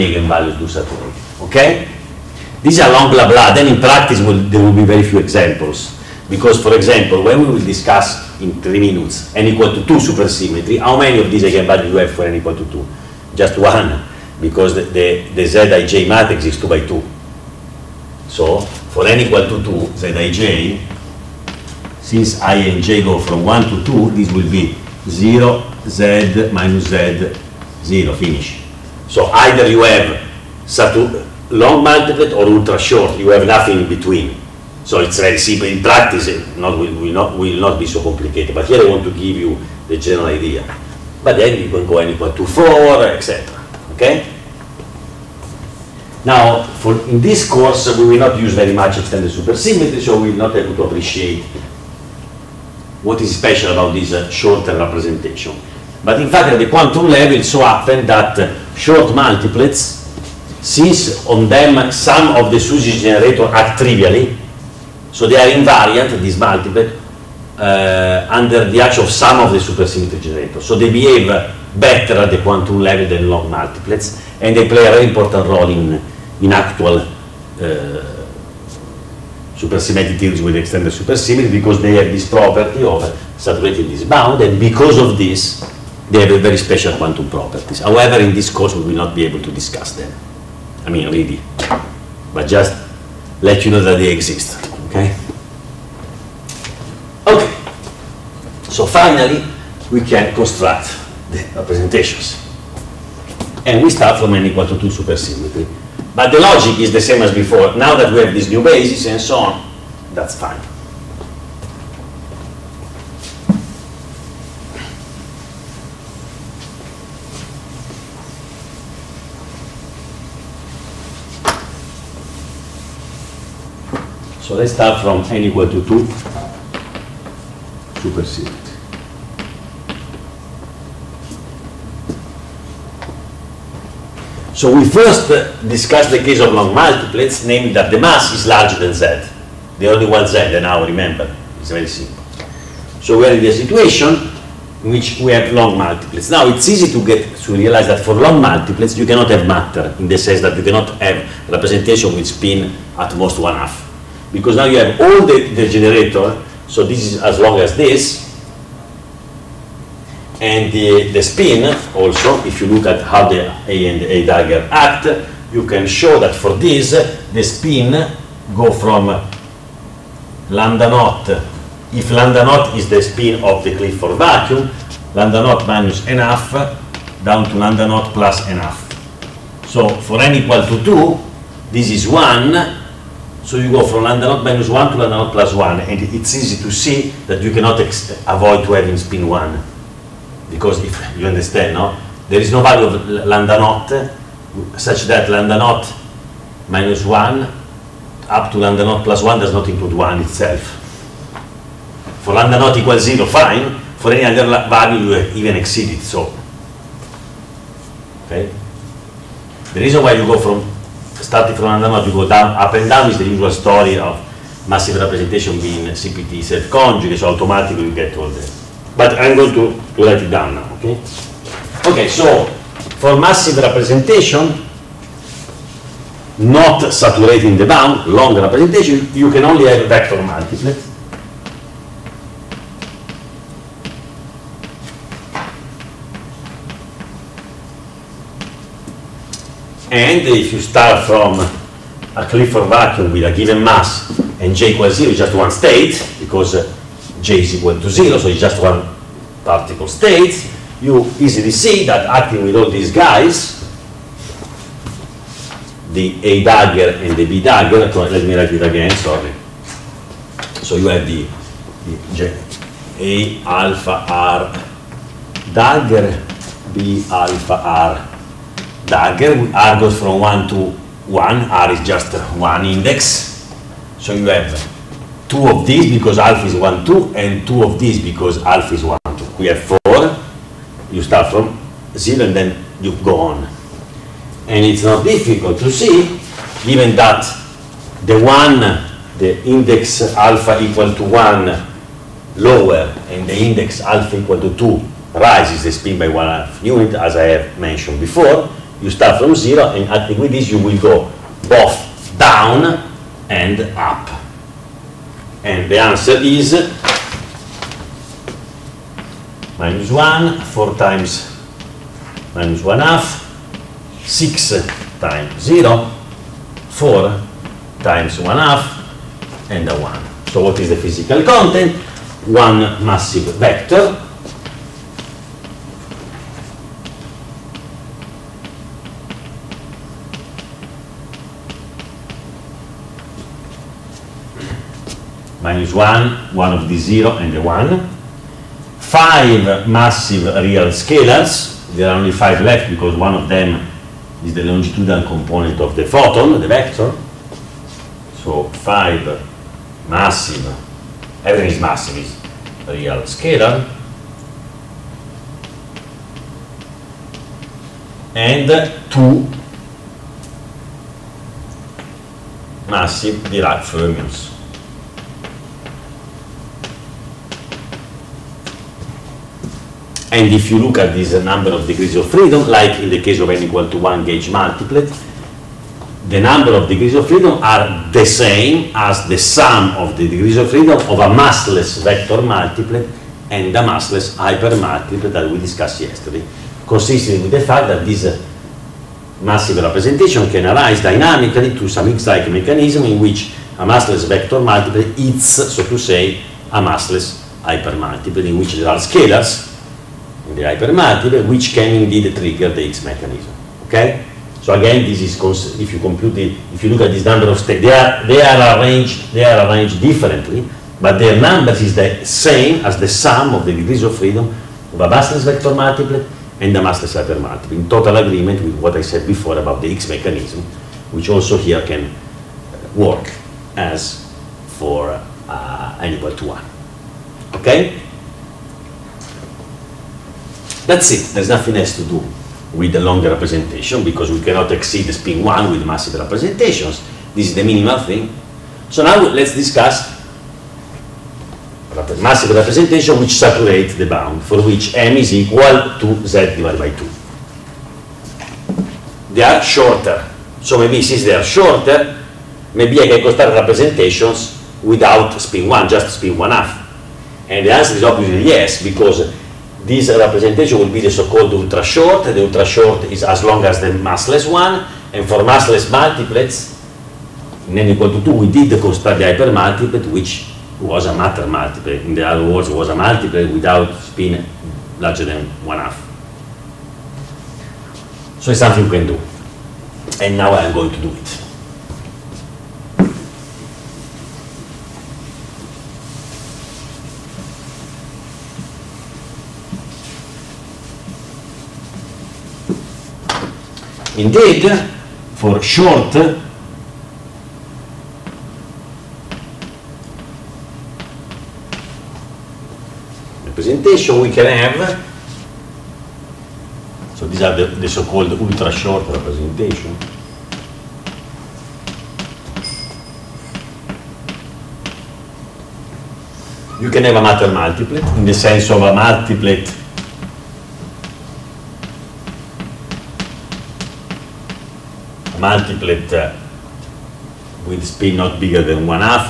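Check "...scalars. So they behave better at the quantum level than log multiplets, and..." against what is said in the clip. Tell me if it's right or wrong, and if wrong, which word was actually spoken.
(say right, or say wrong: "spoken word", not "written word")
wrong: "generators", not "scalars".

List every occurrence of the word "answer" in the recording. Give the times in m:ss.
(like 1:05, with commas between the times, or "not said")
5:05, 7:37.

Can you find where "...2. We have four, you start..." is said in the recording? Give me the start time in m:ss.
4:39.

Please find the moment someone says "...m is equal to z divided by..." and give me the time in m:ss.
7:24.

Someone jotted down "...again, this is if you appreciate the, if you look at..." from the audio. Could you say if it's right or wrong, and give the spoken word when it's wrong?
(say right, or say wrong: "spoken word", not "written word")
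wrong: "compute", not "appreciate".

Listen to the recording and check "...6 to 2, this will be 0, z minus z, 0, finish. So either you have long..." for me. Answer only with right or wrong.
wrong.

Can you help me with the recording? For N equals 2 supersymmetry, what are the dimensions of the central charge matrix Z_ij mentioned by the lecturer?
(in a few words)
2 by 2.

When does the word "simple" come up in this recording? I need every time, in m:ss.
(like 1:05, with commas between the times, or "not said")
0:35, 2:21.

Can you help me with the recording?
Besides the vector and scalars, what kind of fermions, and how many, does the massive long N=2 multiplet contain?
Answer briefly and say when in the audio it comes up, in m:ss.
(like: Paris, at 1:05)
2 massive Dirac fermions, at 5:58.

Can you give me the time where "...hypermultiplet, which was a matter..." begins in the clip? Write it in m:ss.
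7:49.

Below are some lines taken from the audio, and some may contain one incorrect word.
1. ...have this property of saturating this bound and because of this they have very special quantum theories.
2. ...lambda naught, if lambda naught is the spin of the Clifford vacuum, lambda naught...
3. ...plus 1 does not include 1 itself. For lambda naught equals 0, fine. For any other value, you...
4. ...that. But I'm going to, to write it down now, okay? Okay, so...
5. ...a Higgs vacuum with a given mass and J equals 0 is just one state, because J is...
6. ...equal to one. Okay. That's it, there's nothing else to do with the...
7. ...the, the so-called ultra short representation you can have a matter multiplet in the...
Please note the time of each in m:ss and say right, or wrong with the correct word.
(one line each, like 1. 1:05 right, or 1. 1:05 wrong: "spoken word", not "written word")
1. 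1:21 wrong: "properties", not "theories"
2. 2:50 right
3. 3:19 right
4. 3:38 right
5. 4:02 wrong: "Clifford", not "Higgs"
6. 7:05 right
7. 8:27 right.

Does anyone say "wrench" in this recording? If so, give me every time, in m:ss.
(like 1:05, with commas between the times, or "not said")
not said.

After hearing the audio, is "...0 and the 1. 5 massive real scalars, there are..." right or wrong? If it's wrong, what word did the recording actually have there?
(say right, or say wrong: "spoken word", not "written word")
right.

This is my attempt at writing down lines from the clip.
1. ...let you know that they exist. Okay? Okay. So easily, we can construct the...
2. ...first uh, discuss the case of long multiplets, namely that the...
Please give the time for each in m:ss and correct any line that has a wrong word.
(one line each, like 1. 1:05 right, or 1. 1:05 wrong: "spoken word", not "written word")
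1. 1:33 wrong: "finally", not "easily"
2. 2:14 right.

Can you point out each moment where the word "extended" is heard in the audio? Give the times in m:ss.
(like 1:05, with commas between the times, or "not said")
0:48, 1:20.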